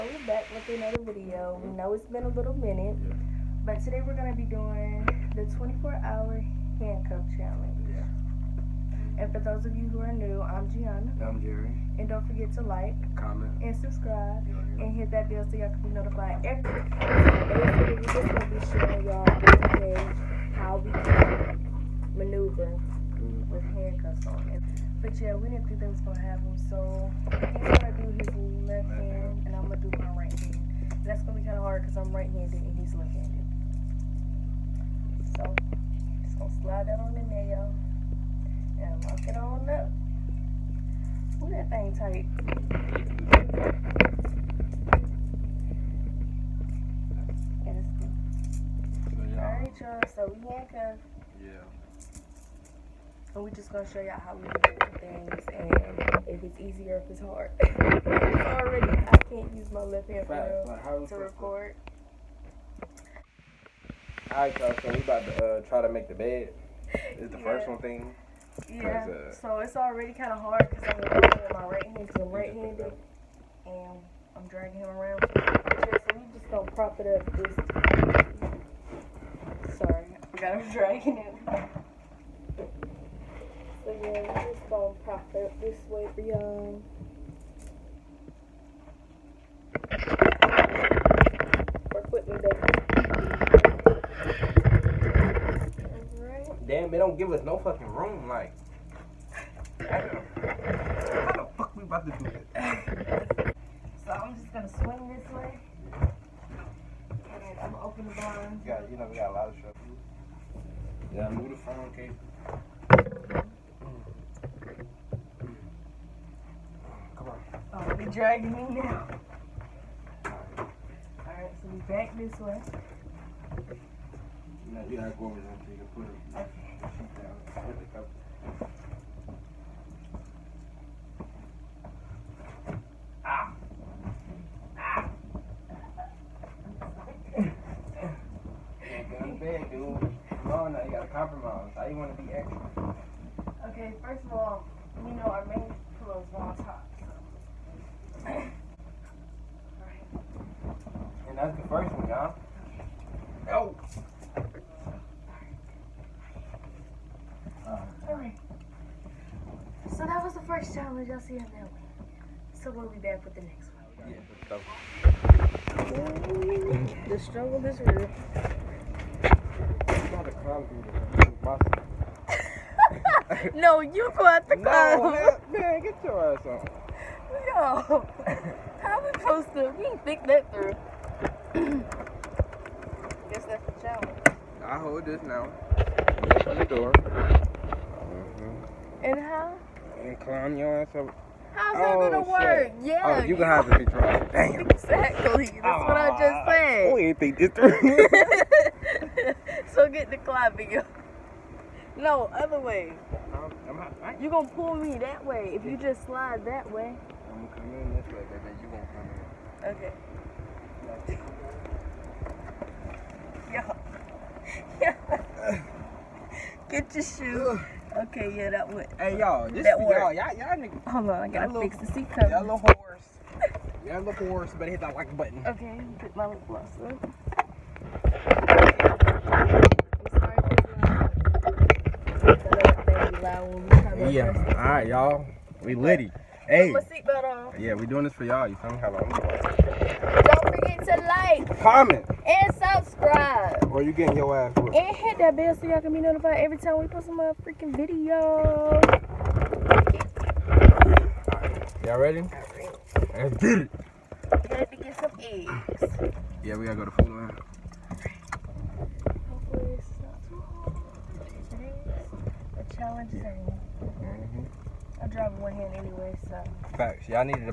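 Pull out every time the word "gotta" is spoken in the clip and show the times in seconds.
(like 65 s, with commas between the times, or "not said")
124 s, 221 s, 256 s.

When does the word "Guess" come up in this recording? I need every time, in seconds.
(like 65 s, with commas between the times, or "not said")
183 s.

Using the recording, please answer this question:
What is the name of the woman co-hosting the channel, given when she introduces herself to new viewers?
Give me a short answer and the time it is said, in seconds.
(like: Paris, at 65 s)
Gianna, at 10 s.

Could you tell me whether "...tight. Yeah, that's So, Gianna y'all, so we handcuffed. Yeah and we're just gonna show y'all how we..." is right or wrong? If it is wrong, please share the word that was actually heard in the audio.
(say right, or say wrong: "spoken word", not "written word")
wrong: "Alright", not "Gianna".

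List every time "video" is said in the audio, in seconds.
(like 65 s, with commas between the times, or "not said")
1 s, 247 s.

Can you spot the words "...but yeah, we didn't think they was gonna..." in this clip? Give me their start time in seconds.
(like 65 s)
25 s.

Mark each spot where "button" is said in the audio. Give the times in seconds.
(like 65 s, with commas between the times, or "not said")
225 s.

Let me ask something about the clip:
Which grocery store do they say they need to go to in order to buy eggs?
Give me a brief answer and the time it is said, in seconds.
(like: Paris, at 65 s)
Food Lion, at 256 s.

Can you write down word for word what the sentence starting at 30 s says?
And that's gonna be kind of hard because I'm right-handed and he's left-handed.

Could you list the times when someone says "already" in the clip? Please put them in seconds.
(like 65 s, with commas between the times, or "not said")
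58 s, 69 s.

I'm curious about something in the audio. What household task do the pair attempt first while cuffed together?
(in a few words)
Make the bed.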